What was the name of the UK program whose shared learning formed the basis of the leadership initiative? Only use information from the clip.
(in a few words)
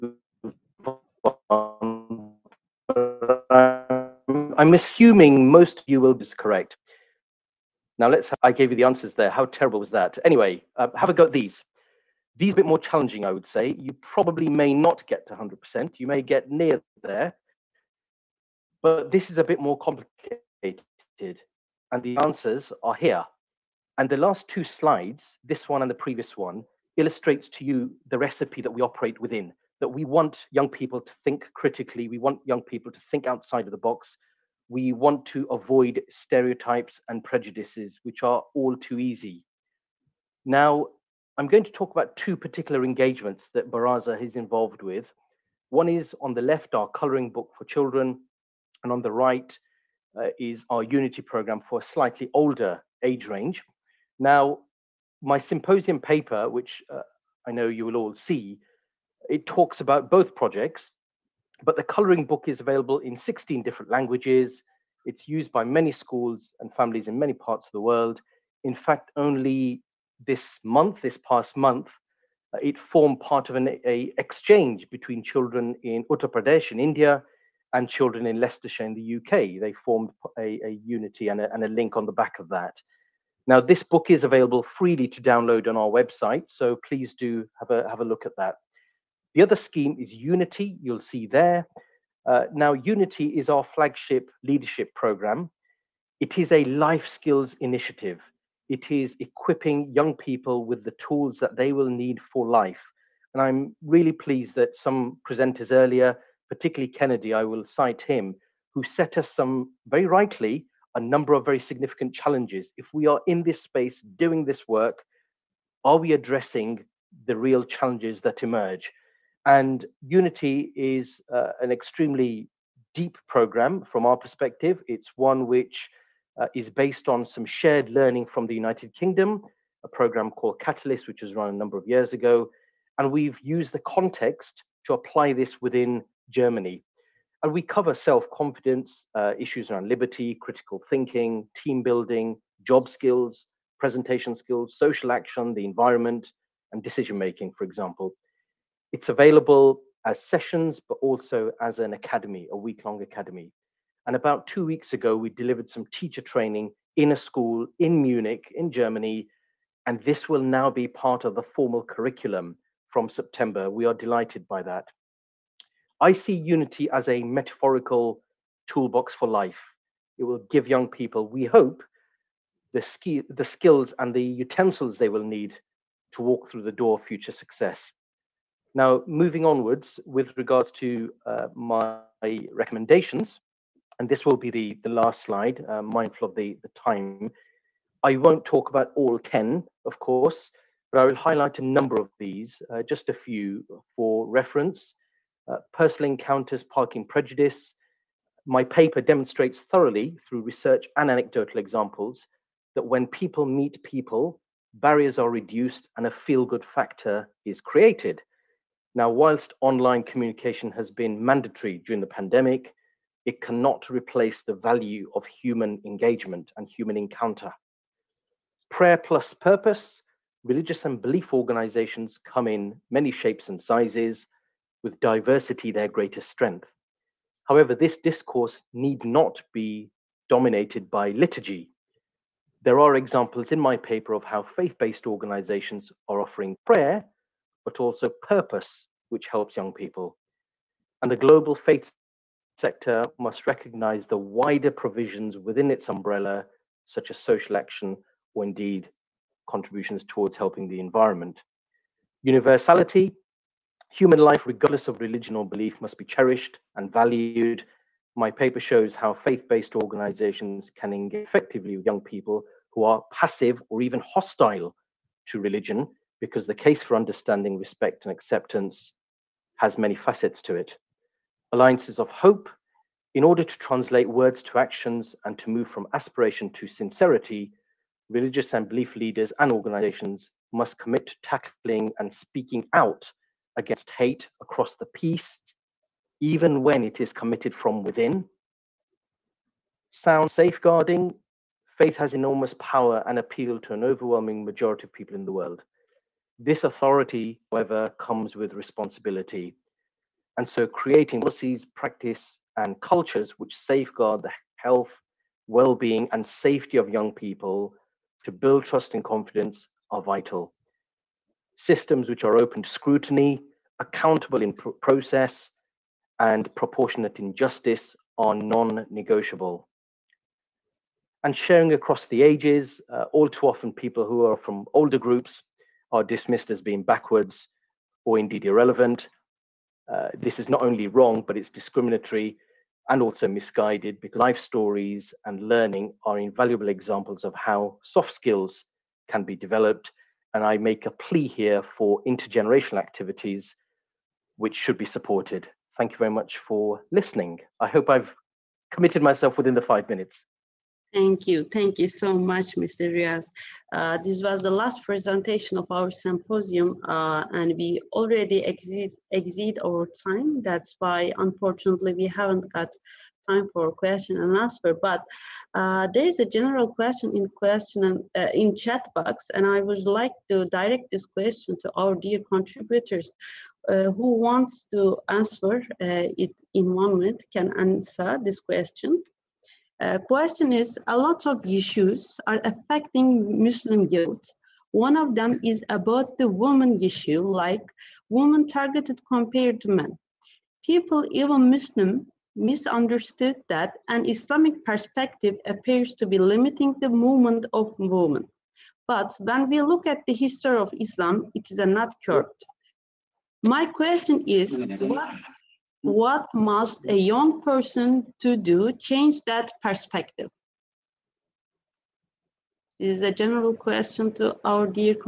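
Catalyst.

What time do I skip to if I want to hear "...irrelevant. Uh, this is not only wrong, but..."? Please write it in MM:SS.
05:28.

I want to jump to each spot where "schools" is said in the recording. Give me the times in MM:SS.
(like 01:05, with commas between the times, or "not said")
01:05, 02:37.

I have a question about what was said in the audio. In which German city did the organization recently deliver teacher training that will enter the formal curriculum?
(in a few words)
Munich.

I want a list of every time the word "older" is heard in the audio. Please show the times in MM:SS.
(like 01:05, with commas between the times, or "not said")
00:52, 05:24.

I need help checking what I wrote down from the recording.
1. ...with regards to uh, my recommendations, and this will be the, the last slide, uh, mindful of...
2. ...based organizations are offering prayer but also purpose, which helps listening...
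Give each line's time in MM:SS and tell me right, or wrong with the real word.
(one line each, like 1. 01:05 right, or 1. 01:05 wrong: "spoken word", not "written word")
1. 03:00 right
2. 03:54 wrong: "young", not "listening".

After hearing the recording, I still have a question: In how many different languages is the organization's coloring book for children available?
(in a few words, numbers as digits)
16.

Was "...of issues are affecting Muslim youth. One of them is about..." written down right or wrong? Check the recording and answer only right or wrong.
right.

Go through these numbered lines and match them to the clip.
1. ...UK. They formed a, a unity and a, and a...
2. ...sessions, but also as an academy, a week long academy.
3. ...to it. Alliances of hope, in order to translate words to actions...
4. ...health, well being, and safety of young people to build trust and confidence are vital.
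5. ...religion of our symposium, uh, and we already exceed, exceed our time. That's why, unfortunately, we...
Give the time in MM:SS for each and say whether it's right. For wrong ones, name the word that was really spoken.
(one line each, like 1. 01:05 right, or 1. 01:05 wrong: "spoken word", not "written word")
1. 01:19 right
2. 02:30 right
3. 04:30 right
4. 05:04 right
5. 05:54 wrong: "presentation", not "religion".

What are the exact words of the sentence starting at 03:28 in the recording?
Now, whilst online communication has been mandatory during the pandemic, it cannot replace the value of human engagement and human encounter.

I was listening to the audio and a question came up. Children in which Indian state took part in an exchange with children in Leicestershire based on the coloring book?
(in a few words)
Uttar Pradesh.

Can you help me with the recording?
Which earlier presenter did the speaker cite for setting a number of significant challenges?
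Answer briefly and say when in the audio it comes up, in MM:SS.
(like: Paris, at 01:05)
Kennedy, at 01:46.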